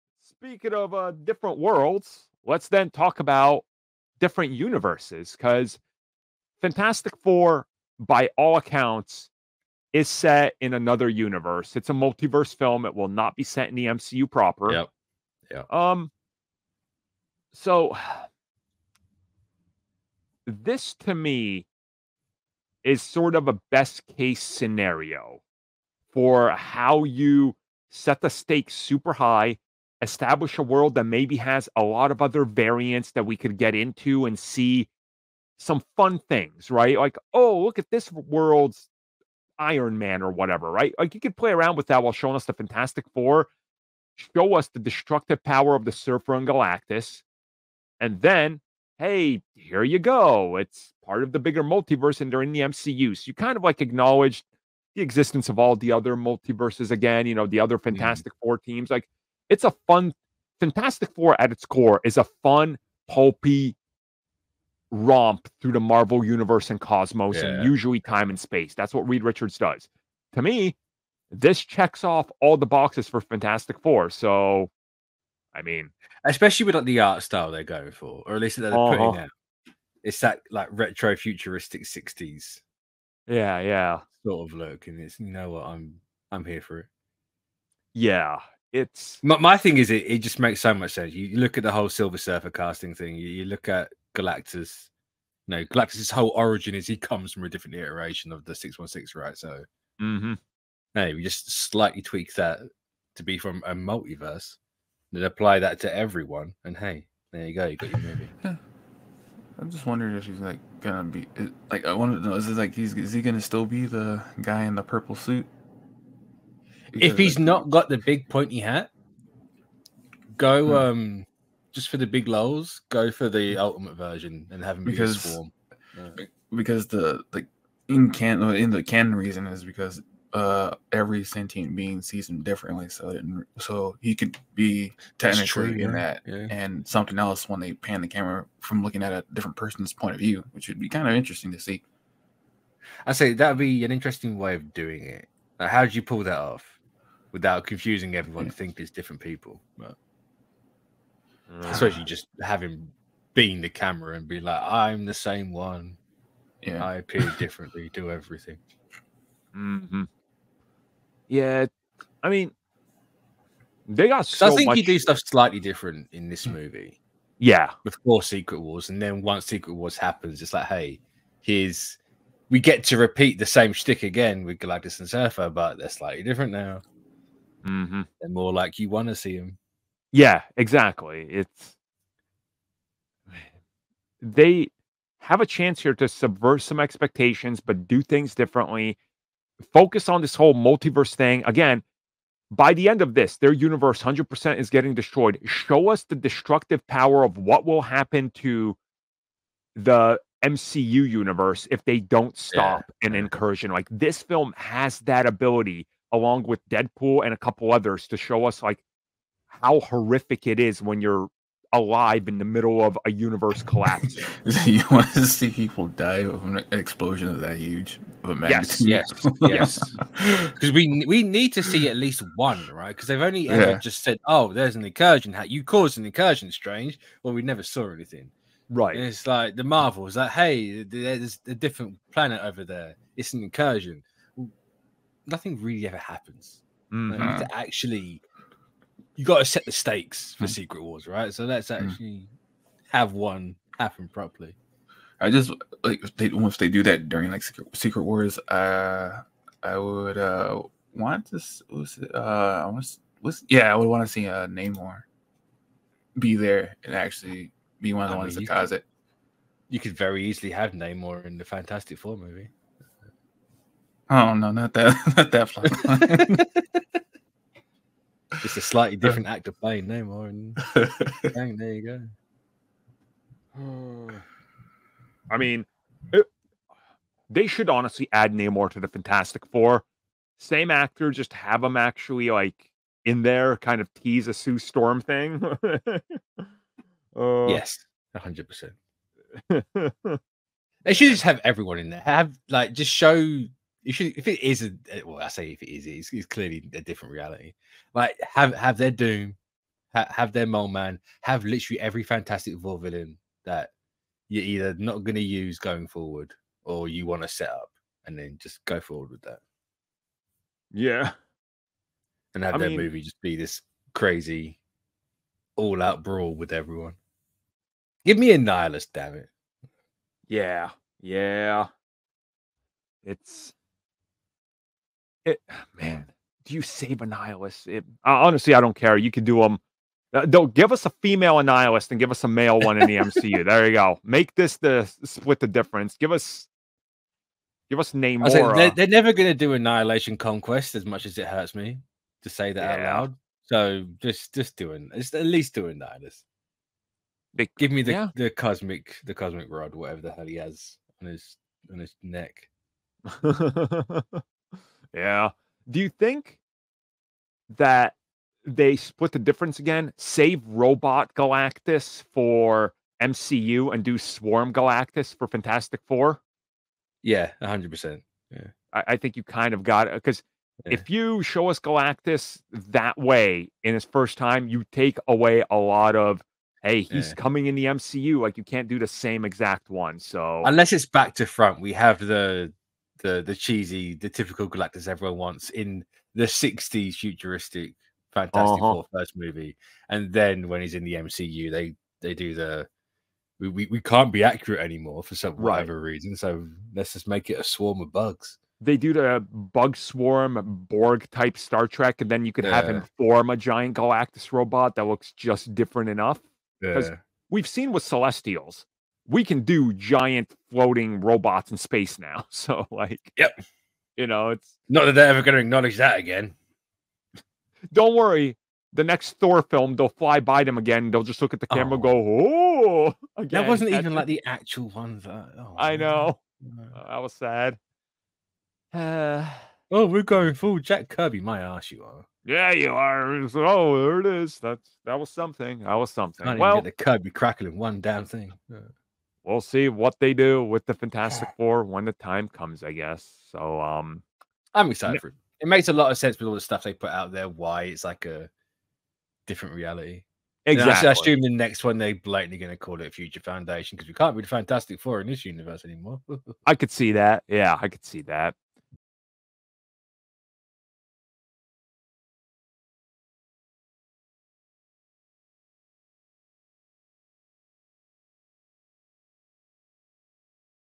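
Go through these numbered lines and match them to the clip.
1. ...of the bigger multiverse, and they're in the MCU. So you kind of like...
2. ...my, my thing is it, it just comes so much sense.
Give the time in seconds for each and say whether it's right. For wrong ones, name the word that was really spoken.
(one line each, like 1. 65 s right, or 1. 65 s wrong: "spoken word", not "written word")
1. 51 s right
2. 89 s wrong: "makes", not "comes".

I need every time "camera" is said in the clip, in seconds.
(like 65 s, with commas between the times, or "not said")
138 s, 153 s, 421 s.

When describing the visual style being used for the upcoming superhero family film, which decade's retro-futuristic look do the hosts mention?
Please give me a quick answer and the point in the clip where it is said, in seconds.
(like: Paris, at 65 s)
Sixties, at 81 s.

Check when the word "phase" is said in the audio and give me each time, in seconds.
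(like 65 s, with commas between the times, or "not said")
not said.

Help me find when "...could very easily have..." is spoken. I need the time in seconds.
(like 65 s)
259 s.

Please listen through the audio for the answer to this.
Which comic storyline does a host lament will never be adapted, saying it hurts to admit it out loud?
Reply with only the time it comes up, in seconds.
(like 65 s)
339 s.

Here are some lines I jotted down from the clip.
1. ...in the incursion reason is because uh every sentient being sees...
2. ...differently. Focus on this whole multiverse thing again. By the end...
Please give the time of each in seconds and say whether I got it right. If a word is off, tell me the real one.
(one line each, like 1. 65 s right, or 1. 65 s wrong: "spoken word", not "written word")
1. 128 s wrong: "canon", not "incursion"
2. 188 s right.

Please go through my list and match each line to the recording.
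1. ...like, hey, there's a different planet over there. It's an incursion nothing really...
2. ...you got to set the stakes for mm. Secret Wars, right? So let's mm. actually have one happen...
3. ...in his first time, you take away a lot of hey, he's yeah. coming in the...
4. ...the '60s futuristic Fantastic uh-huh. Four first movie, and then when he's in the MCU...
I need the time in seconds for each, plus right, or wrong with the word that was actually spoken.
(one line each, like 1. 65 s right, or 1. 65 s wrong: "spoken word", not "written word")
1. 230 s right
2. 239 s right
3. 373 s right
4. 386 s right.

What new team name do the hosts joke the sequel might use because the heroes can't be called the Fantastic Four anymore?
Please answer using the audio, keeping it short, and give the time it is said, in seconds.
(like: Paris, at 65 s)
Future Foundation, at 452 s.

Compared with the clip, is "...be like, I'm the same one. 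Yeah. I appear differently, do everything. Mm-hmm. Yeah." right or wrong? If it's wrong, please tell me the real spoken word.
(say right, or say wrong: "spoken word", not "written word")
right.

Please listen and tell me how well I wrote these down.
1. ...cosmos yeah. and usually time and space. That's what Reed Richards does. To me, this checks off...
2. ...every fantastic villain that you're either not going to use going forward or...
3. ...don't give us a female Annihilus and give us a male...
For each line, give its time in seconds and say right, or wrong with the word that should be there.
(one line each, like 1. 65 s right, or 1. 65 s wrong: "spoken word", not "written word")
1. 66 s right
2. 301 s right
3. 330 s right.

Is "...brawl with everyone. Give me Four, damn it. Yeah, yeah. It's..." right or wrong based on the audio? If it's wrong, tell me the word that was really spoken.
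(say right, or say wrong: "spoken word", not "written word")
wrong: "Annihilus", not "Four".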